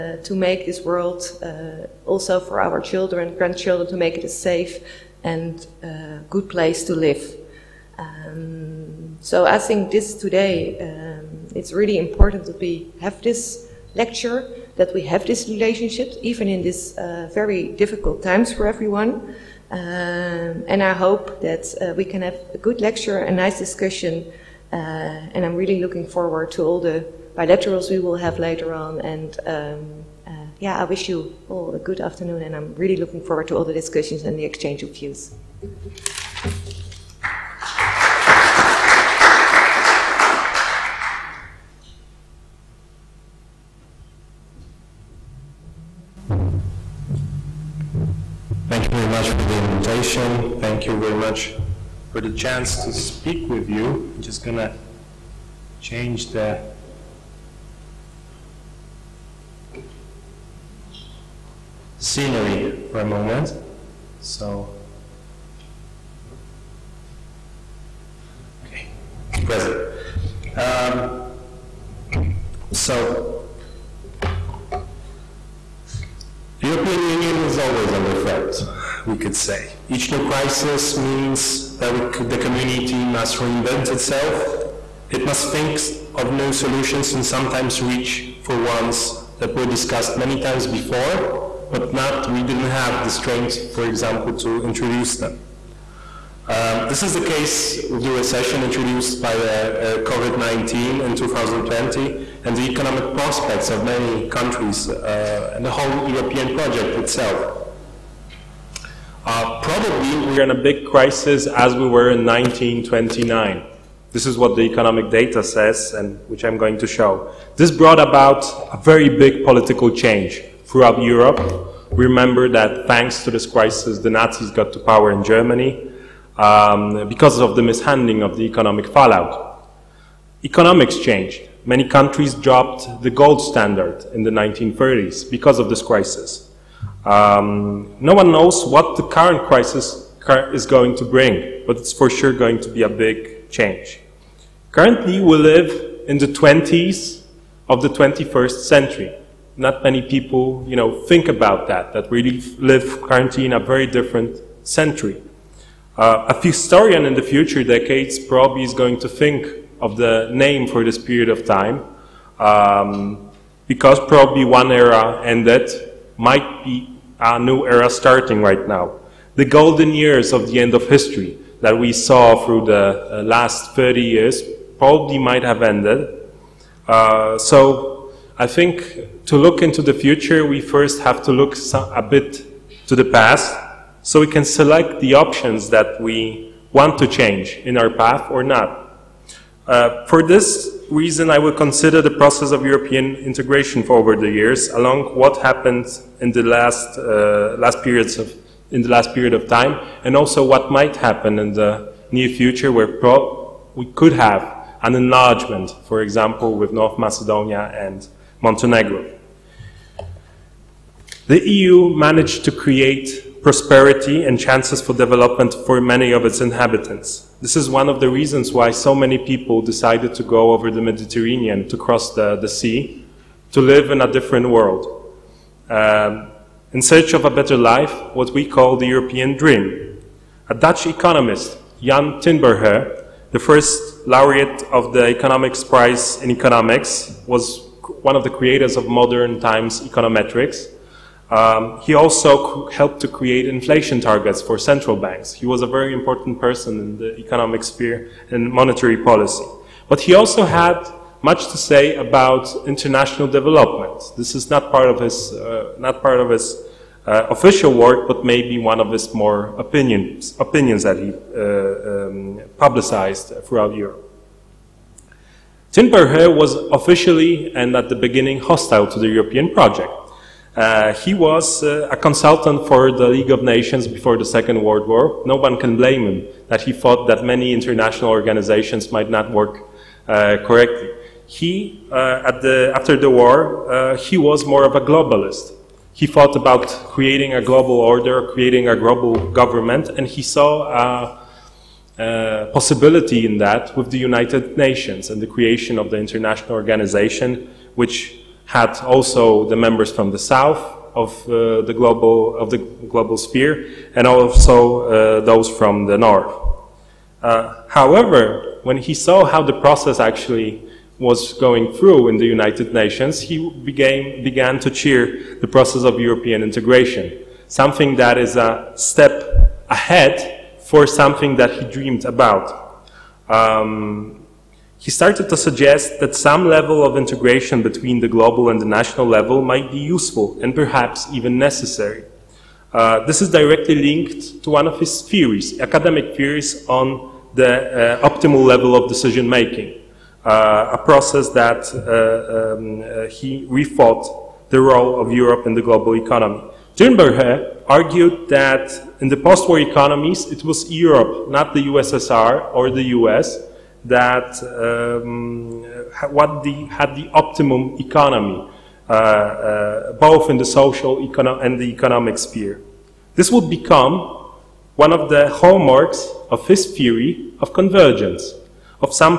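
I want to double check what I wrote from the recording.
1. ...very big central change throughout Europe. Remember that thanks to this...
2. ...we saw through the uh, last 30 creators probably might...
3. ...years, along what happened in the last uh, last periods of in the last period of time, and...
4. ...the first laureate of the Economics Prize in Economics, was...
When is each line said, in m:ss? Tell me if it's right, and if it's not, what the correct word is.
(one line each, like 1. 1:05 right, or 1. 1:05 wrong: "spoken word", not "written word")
1. 1:58 wrong: "political", not "central"
2. 2:51 wrong: "years", not "creators"
3. 3:14 right
4. 3:53 right.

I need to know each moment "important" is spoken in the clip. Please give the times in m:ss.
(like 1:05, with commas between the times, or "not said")
0:11, 4:05.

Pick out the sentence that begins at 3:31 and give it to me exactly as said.
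The EU managed to create prosperity and chances for development for many of its inhabitants.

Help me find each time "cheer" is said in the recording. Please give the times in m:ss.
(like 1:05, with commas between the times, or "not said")
5:14.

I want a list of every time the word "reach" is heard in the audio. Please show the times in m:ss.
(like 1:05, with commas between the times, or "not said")
1:27.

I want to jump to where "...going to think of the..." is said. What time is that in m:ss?
2:38.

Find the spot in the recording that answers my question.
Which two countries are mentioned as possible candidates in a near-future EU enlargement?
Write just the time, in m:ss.
3:26.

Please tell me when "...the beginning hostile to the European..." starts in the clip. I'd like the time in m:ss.
4:27.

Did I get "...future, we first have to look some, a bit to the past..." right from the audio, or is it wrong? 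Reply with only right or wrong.
right.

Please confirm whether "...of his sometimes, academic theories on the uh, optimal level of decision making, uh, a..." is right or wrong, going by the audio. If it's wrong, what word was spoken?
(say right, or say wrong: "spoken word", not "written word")
wrong: "theories", not "sometimes".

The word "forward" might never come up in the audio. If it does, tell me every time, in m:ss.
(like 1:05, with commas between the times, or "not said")
0:26, 0:33.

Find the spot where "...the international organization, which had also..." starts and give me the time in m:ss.
4:55.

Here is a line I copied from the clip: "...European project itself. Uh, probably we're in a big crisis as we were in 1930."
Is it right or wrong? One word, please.
wrong.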